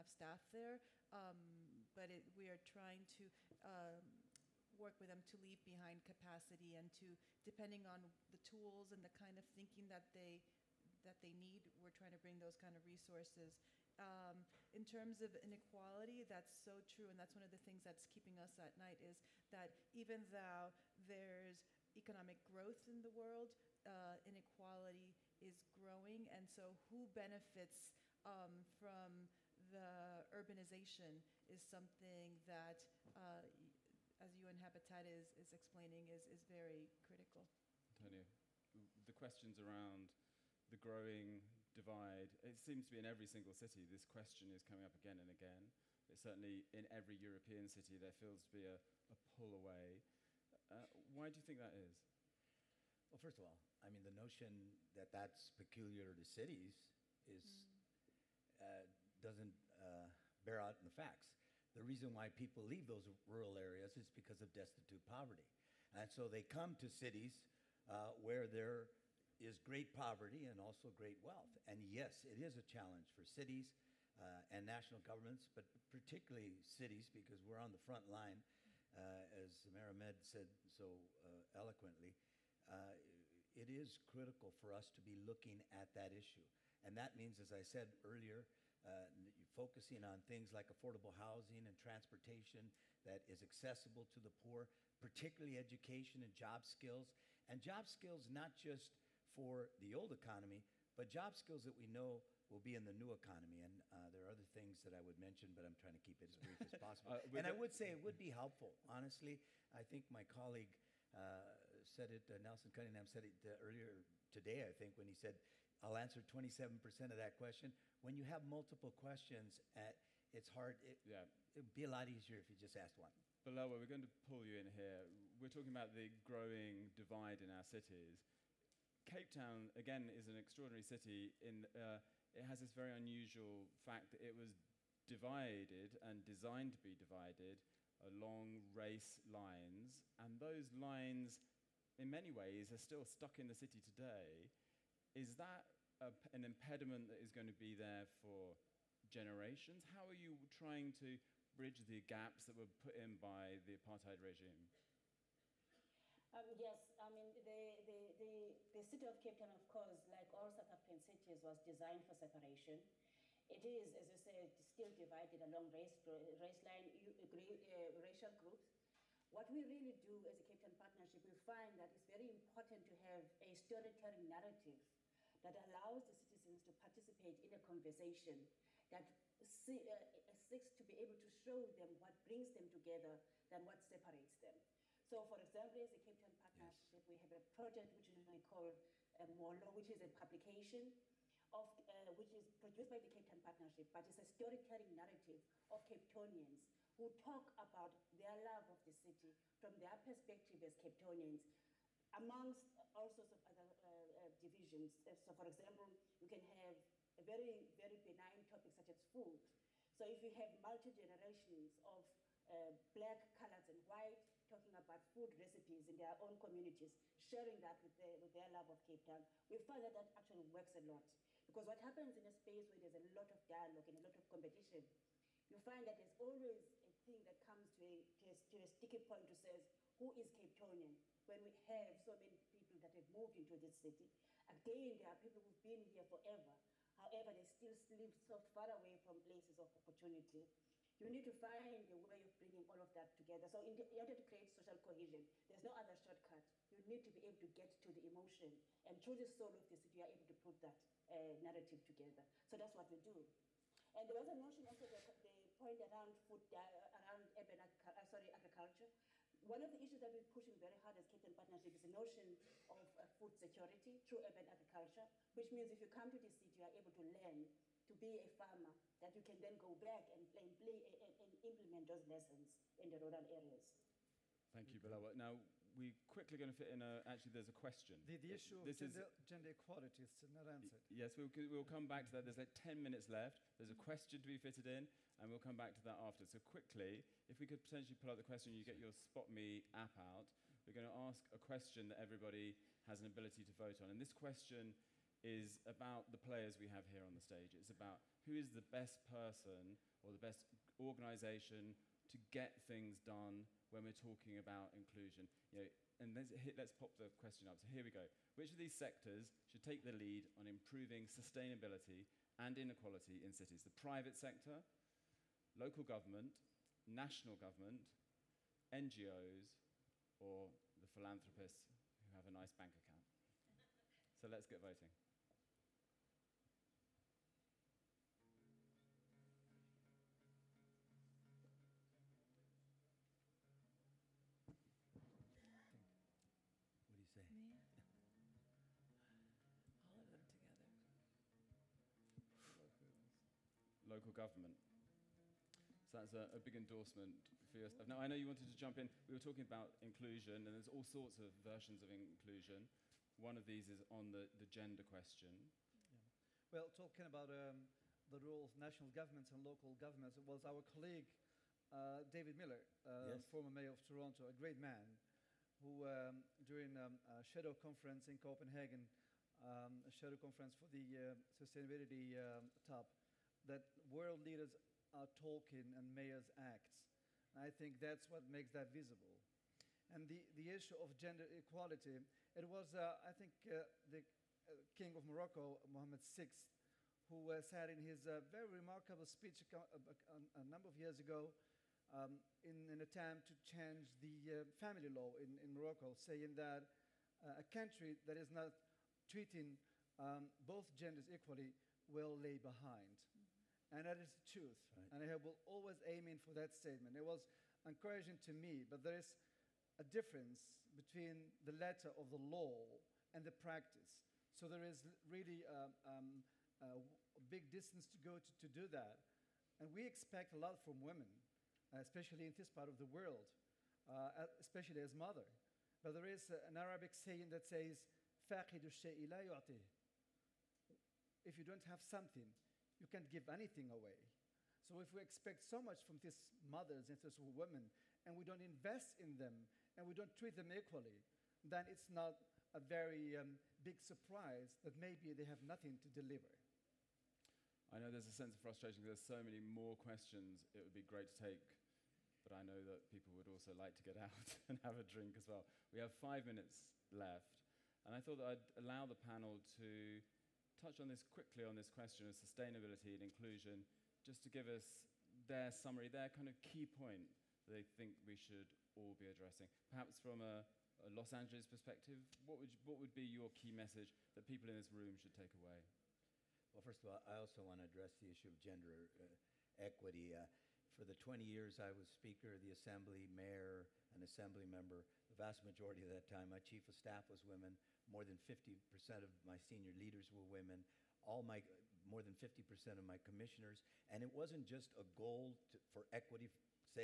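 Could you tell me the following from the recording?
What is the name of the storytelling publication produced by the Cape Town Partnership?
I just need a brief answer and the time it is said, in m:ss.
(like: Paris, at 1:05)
Molo, at 3:09.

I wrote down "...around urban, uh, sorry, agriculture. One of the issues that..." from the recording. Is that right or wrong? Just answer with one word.
right.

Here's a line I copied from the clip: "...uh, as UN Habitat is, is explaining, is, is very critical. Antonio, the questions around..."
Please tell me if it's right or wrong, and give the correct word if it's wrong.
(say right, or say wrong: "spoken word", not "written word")
right.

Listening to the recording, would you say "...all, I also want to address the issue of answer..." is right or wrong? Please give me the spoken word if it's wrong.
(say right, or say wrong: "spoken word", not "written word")
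wrong: "gender", not "answer".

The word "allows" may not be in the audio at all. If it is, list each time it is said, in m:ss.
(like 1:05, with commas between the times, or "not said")
2:55, 7:38.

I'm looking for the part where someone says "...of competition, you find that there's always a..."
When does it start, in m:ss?
3:44.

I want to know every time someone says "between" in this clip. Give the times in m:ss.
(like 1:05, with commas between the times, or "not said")
6:50.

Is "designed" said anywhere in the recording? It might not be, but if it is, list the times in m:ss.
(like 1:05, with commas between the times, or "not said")
2:16, 2:41.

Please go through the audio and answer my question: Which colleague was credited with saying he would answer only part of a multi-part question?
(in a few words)
Nelson Cunningham.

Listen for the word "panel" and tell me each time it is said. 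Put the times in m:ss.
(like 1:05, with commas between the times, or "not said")
7:38.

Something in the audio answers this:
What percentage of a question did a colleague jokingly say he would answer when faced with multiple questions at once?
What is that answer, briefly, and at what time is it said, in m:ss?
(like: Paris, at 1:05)
27%, at 1:56.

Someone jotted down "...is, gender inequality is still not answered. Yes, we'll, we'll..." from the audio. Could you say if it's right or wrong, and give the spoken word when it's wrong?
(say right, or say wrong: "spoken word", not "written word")
wrong: "equality", not "inequality".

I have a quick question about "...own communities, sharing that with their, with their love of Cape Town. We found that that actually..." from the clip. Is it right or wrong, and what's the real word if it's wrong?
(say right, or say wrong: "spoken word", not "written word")
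right.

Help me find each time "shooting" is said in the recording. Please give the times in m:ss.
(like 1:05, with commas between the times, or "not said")
not said.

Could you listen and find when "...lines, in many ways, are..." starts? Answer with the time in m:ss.
2:20.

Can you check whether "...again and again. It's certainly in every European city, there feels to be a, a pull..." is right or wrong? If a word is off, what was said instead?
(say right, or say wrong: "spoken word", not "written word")
right.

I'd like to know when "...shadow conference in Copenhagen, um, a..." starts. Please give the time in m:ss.
6:07.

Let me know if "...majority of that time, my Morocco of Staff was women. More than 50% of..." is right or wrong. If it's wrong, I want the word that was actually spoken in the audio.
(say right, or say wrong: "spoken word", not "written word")
wrong: "Chief", not "Morocco".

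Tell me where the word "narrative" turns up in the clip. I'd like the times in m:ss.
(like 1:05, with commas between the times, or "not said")
2:54, 3:14, 4:11.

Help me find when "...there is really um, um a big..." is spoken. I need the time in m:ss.
6:54.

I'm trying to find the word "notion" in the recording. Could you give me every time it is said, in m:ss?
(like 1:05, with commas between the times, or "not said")
0:54, 4:14, 4:21.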